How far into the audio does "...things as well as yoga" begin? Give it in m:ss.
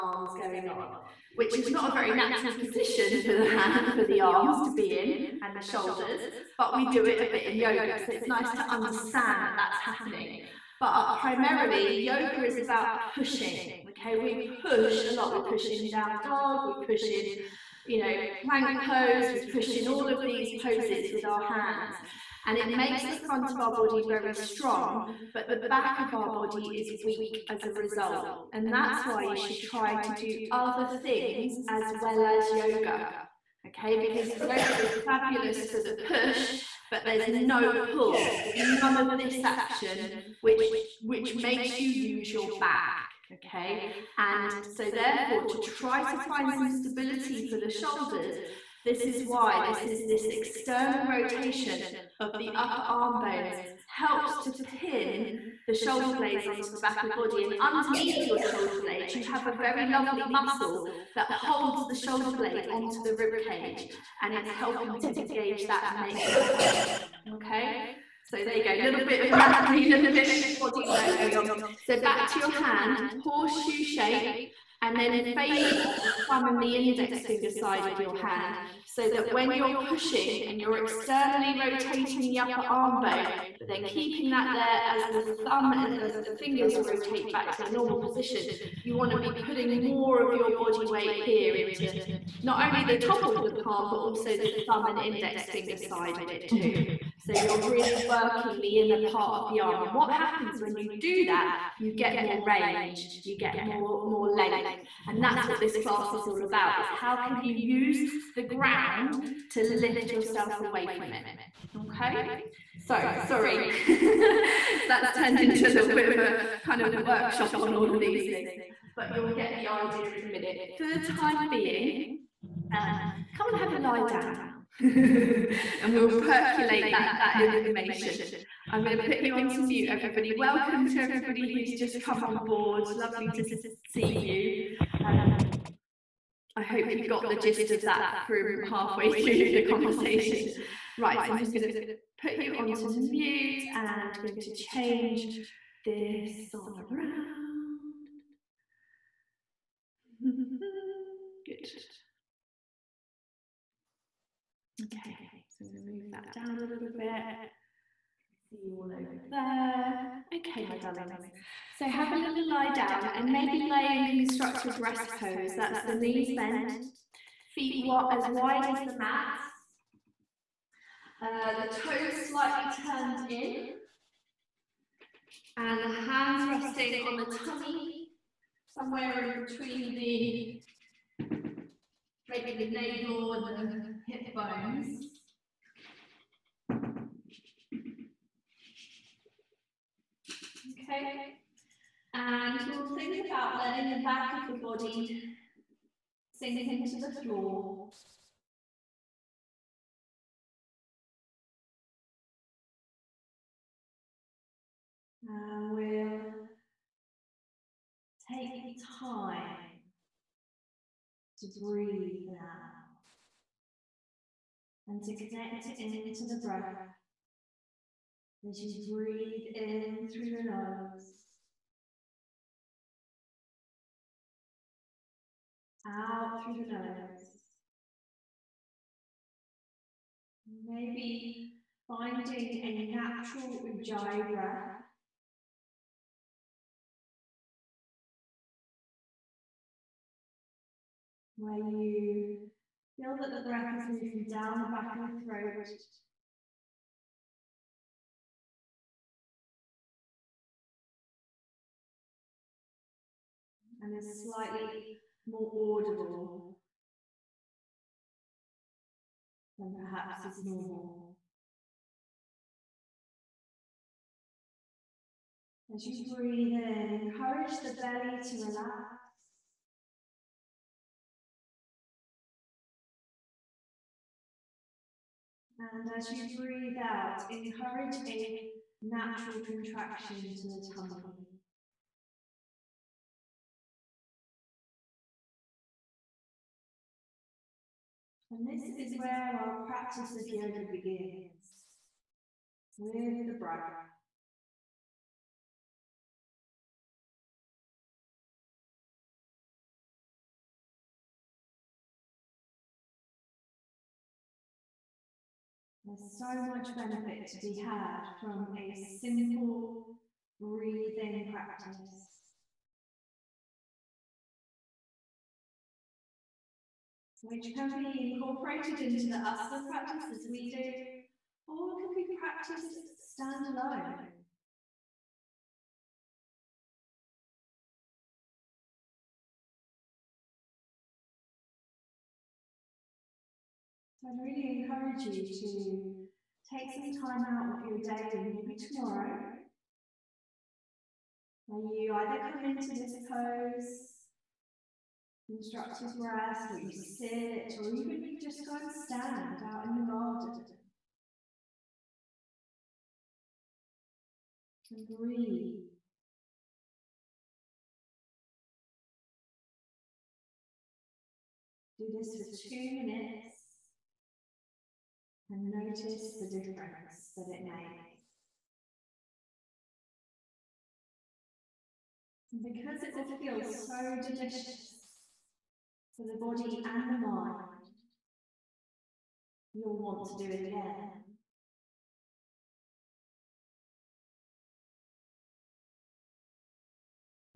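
0:31.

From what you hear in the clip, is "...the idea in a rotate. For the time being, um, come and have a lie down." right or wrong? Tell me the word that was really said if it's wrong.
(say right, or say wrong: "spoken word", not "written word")
wrong: "minute", not "rotate".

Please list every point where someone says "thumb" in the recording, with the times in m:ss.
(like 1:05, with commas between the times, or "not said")
1:16, 1:25, 1:34.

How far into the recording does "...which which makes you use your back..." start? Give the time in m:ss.
0:40.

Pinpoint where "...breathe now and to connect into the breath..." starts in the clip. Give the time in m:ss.
3:31.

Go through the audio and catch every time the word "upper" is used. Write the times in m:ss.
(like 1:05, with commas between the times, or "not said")
0:52, 1:22.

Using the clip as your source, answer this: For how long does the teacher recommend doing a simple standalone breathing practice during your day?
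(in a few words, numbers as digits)
2 minutes.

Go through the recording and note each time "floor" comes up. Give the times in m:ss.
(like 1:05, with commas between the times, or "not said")
3:17.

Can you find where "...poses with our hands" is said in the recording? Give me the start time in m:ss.
0:20.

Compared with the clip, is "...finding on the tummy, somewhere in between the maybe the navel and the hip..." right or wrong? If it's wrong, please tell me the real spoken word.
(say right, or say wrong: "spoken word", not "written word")
wrong: "resting", not "finding".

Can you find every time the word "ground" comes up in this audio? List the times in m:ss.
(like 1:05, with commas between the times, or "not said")
1:48.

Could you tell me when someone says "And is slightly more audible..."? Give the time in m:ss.
4:13.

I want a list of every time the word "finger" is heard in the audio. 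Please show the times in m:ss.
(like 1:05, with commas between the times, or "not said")
1:17, 1:26, 1:35.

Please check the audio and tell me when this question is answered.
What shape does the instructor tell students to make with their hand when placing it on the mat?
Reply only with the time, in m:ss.
1:13.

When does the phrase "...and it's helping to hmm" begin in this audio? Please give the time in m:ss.
1:04.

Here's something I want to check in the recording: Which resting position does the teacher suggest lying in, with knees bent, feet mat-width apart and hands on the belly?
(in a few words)
constructive rest pose.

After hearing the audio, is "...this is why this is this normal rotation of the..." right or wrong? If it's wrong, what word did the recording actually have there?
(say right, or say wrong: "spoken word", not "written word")
wrong: "external", not "normal".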